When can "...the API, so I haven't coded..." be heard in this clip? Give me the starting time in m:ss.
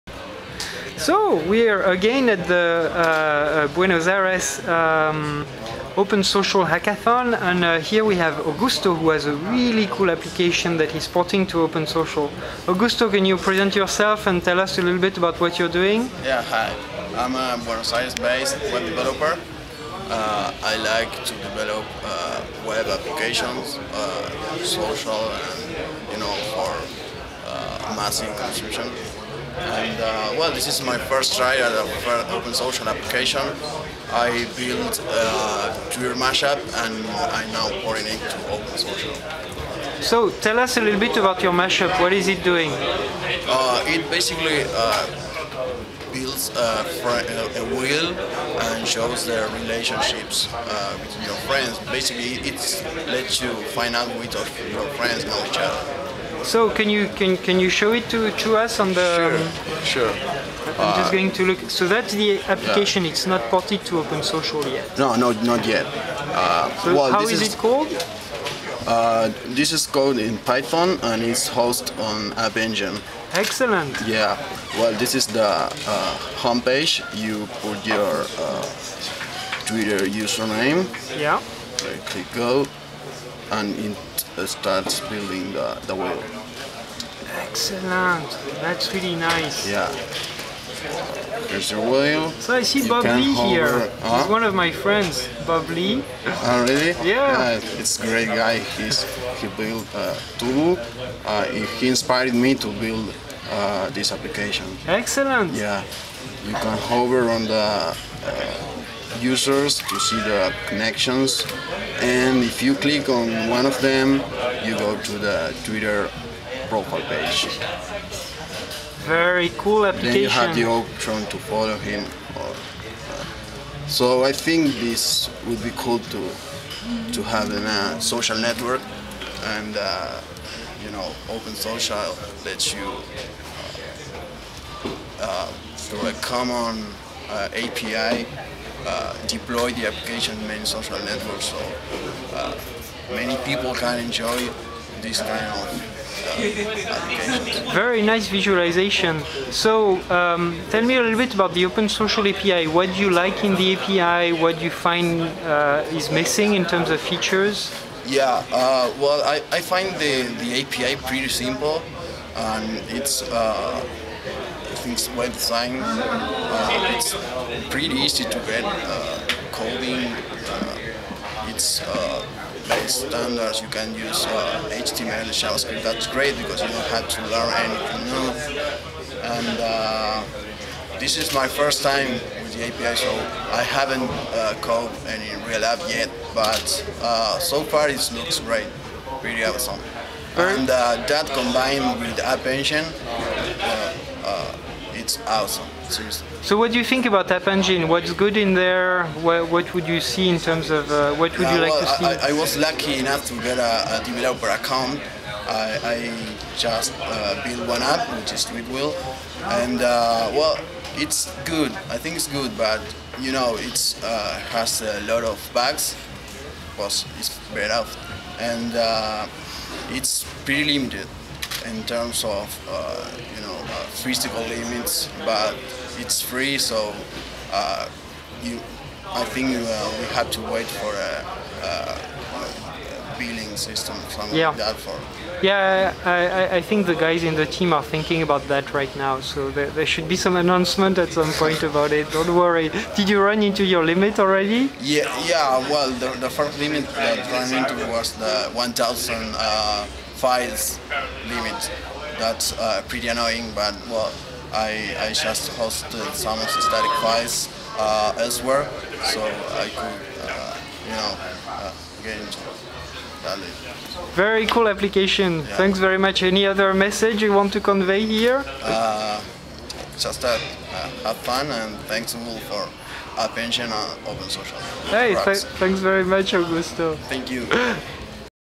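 3:02.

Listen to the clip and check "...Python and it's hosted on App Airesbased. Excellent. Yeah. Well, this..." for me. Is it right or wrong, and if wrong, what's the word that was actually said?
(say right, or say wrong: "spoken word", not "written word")
wrong: "Engine", not "Airesbased".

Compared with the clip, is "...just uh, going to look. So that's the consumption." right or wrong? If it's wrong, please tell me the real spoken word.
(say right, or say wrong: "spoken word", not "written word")
wrong: "application", not "consumption".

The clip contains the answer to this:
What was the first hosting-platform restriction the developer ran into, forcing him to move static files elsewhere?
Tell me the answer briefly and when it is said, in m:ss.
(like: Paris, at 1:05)
1,000 files limit, at 4:08.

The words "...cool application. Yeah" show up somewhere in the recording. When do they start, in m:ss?
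4:24.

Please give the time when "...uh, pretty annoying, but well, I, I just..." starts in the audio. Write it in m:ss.
4:12.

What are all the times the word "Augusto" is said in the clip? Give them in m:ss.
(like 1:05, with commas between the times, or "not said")
0:08, 0:12, 4:36.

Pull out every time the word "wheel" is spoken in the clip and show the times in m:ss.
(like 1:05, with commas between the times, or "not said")
0:47, 1:25, 1:31.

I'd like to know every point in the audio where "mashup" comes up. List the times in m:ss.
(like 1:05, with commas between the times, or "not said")
0:36, 0:41.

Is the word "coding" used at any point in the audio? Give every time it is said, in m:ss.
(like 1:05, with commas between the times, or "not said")
2:49.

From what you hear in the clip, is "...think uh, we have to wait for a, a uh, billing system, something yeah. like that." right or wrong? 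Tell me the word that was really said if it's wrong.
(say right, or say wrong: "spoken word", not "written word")
right.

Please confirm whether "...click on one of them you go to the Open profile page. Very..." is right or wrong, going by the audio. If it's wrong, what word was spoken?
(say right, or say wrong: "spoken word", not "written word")
wrong: "Twitter", not "Open".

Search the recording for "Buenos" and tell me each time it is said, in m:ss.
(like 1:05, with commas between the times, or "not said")
0:03, 0:17.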